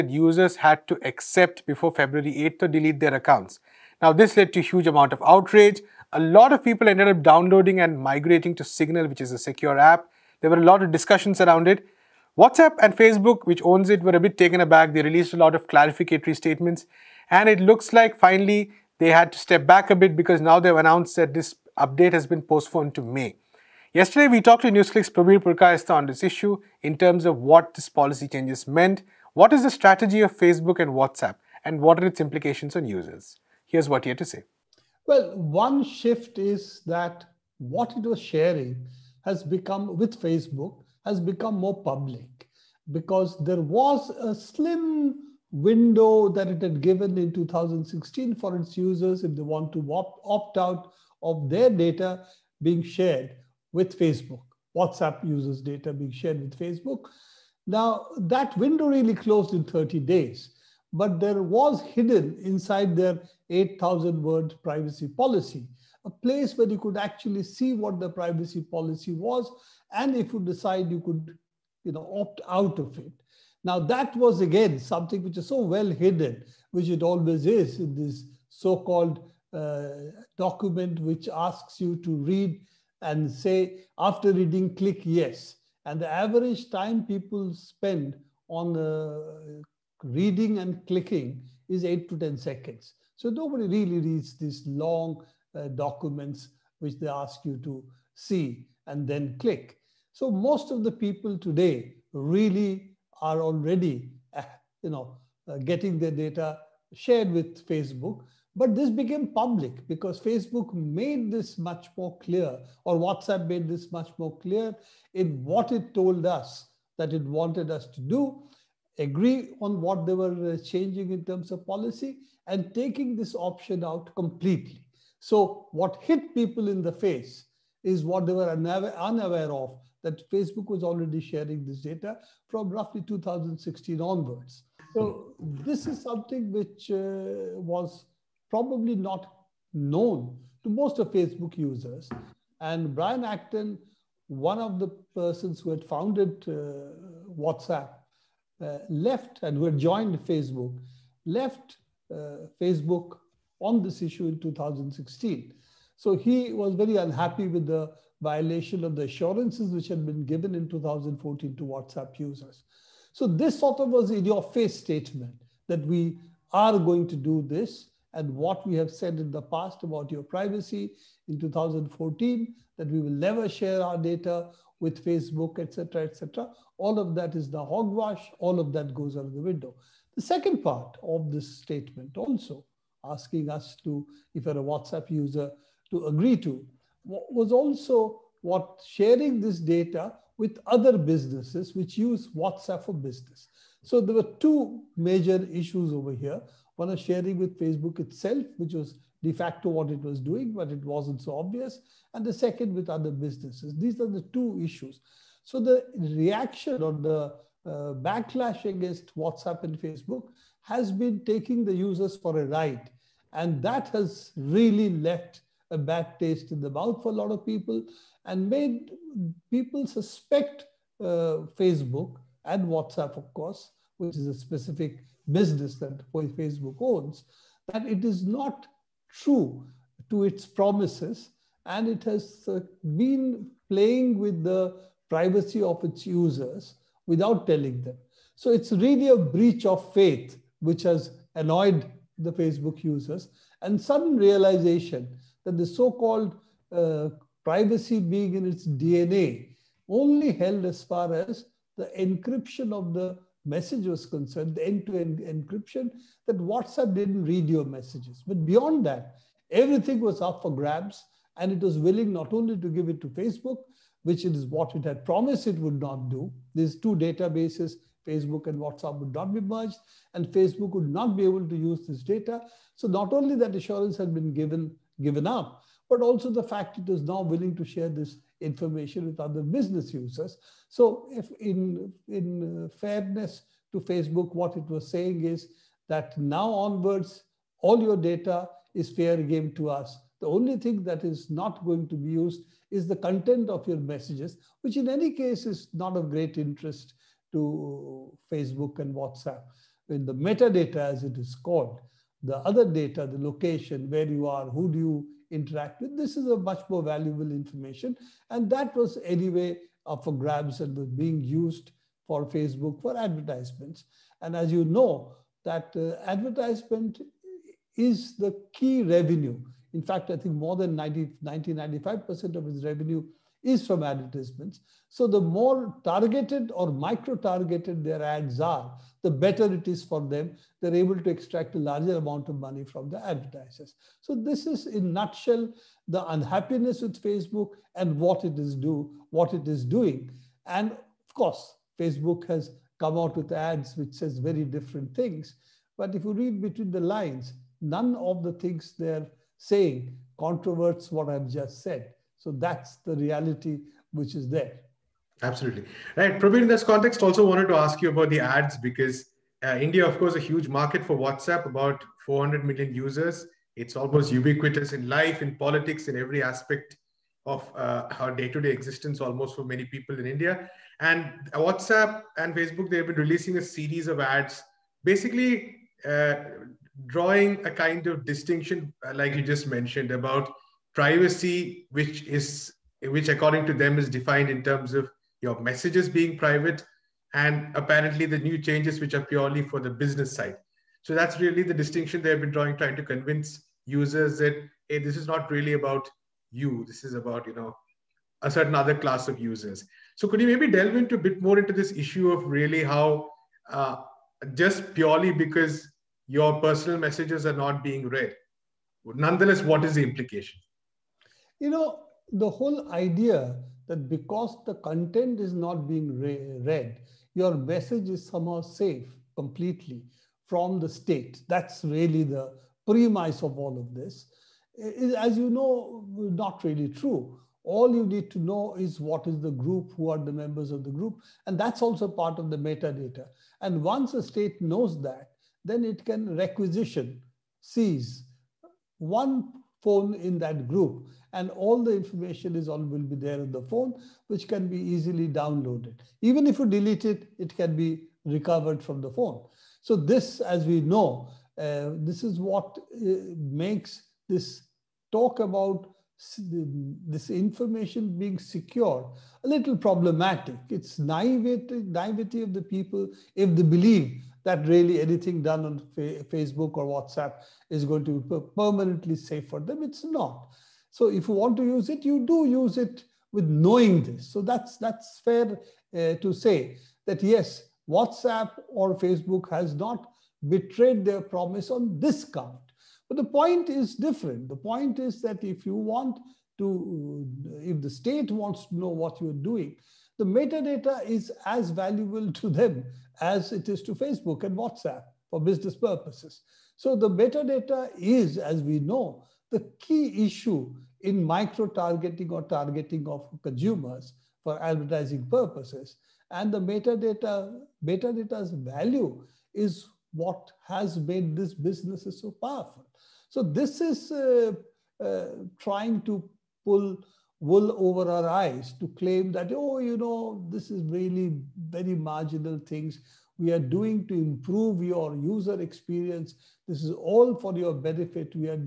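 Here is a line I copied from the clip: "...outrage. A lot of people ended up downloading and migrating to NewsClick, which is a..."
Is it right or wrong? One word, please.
wrong.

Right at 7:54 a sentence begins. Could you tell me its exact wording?
So that's, that's fair uh, to say that yes, WhatsApp or Facebook has not betrayed their promise on this count.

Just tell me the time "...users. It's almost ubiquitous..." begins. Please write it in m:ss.
6:02.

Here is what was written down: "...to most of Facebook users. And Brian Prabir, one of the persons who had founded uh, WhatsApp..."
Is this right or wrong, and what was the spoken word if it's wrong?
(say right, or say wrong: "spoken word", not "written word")
wrong: "Acton", not "Prabir".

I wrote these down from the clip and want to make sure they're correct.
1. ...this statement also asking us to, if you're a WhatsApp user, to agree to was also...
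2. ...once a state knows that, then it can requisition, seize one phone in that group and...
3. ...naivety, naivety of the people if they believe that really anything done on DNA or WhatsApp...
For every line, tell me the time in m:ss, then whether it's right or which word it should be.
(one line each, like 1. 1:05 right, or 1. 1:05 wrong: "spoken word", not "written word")
1. 3:01 right
2. 7:13 right
3. 7:40 wrong: "Facebook", not "DNA".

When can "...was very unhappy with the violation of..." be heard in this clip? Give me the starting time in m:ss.
2:36.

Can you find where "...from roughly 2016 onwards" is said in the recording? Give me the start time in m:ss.
2:12.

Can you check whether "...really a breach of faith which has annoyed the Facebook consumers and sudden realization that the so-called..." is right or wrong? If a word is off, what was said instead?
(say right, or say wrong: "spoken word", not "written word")
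wrong: "users", not "consumers".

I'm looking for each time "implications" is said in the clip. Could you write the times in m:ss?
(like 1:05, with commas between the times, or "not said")
0:32, 6:49.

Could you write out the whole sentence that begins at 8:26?
And the metadata, metadata's value is what has made this business so powerful.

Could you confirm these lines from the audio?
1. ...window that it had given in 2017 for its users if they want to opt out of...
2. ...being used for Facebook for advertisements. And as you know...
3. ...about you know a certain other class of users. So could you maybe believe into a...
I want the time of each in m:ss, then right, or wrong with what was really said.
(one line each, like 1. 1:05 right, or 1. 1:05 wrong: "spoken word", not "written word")
1. 0:45 wrong: "2016", not "2017"
2. 5:10 right
3. 6:36 wrong: "delve", not "believe".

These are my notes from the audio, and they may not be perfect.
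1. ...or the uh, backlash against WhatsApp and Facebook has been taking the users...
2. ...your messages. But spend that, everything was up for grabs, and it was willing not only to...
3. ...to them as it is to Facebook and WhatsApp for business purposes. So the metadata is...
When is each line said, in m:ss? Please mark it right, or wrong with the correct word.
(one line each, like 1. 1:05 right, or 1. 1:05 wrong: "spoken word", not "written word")
1. 3:26 right
2. 4:17 wrong: "beyond", not "spend"
3. 8:12 right.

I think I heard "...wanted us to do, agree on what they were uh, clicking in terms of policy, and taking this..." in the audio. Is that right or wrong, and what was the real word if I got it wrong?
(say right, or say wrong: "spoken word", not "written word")
wrong: "changing", not "clicking".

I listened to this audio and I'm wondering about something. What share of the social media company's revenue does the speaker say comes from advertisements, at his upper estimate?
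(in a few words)
95%.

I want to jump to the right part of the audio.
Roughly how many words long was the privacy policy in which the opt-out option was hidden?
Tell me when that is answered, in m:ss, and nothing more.
1:03.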